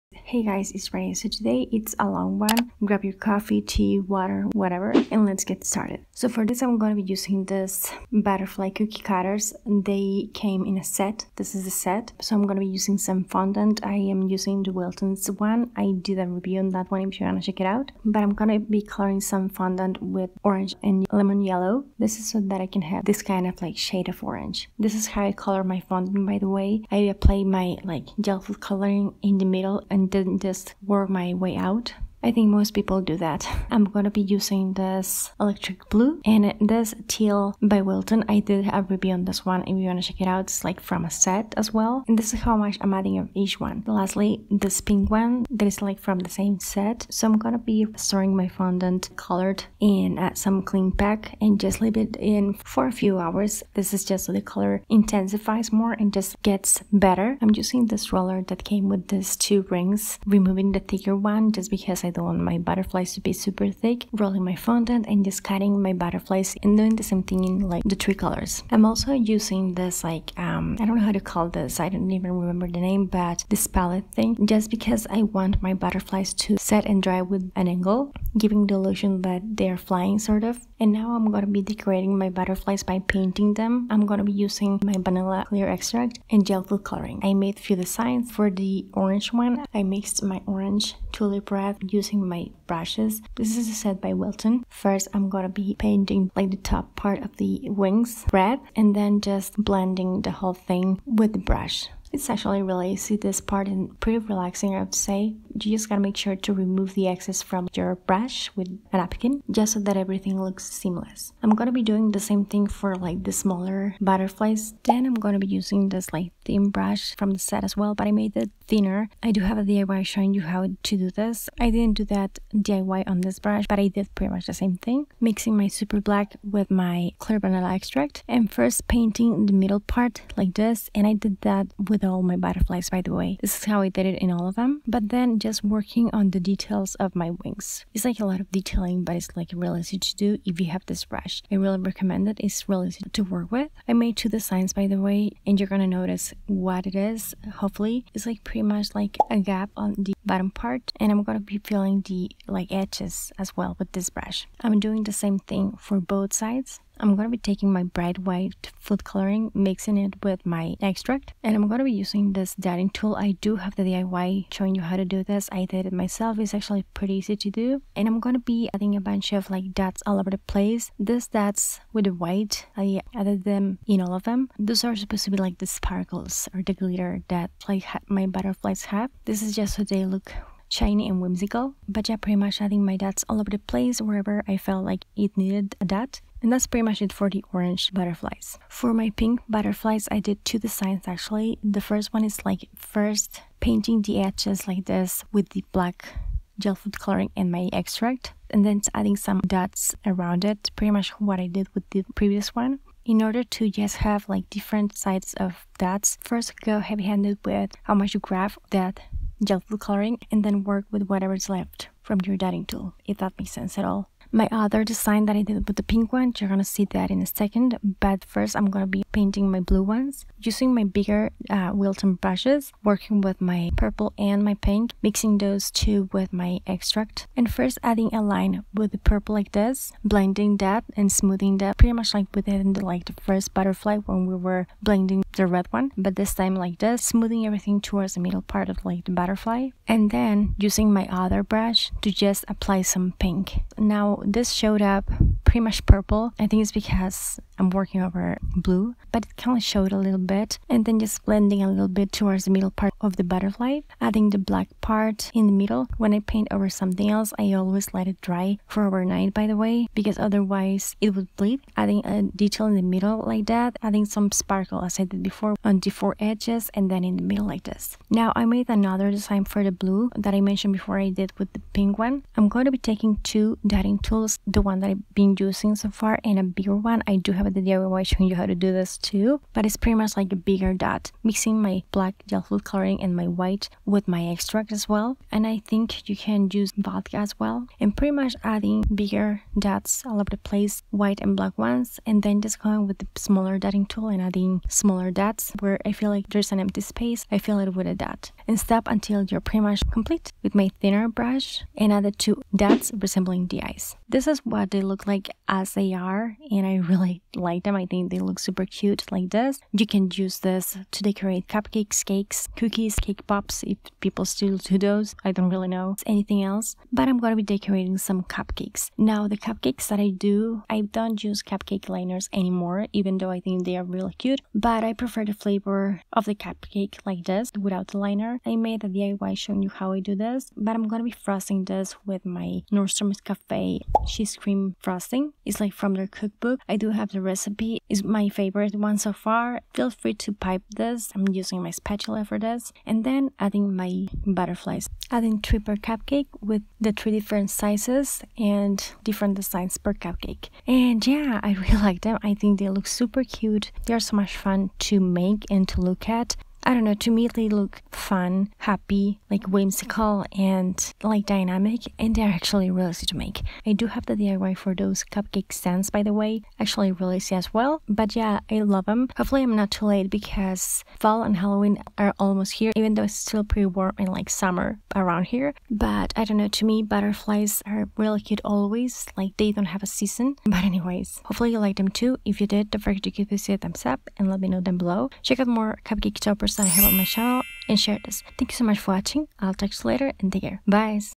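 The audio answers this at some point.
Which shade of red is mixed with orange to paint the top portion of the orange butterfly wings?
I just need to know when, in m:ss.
1:31.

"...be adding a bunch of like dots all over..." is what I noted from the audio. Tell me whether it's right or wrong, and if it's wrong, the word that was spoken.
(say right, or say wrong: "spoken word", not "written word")
right.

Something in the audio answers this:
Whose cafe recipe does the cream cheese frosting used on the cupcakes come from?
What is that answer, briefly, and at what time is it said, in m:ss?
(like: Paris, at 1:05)
Nordstrom's, at 5:32.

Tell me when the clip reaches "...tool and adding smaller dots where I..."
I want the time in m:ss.
4:53.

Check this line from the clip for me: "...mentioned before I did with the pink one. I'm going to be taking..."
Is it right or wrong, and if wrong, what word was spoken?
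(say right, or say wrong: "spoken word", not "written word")
right.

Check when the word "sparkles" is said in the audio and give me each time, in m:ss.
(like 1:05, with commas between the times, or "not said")
2:55, 4:24.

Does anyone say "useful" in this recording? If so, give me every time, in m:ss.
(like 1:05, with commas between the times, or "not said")
not said.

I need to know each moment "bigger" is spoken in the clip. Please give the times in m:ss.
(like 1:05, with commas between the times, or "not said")
3:40, 4:36, 4:40, 4:49.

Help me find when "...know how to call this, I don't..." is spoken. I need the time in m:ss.
1:10.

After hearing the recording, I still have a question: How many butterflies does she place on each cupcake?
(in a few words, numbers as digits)
3.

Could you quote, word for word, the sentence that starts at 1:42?
It's actually really easy, this part and pretty relaxing I would say.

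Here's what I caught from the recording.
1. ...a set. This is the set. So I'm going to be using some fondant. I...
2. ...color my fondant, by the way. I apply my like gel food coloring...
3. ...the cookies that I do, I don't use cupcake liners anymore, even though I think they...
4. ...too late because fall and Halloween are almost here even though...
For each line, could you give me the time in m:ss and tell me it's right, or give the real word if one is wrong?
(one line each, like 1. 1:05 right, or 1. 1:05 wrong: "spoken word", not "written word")
1. 0:10 right
2. 0:25 right
3. 5:19 wrong: "cupcakes", not "cookies"
4. 6:09 right.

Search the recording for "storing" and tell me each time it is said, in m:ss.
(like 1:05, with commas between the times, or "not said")
0:47.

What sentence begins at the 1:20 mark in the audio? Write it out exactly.
And now I'm gonna be decorating my butterflies by painting them.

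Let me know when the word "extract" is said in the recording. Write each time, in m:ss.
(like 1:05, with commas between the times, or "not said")
1:25, 2:07, 2:40, 3:17, 3:46, 4:44.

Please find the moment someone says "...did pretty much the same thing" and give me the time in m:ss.
2:03.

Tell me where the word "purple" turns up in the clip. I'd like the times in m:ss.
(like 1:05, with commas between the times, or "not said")
3:43, 3:48, 4:05.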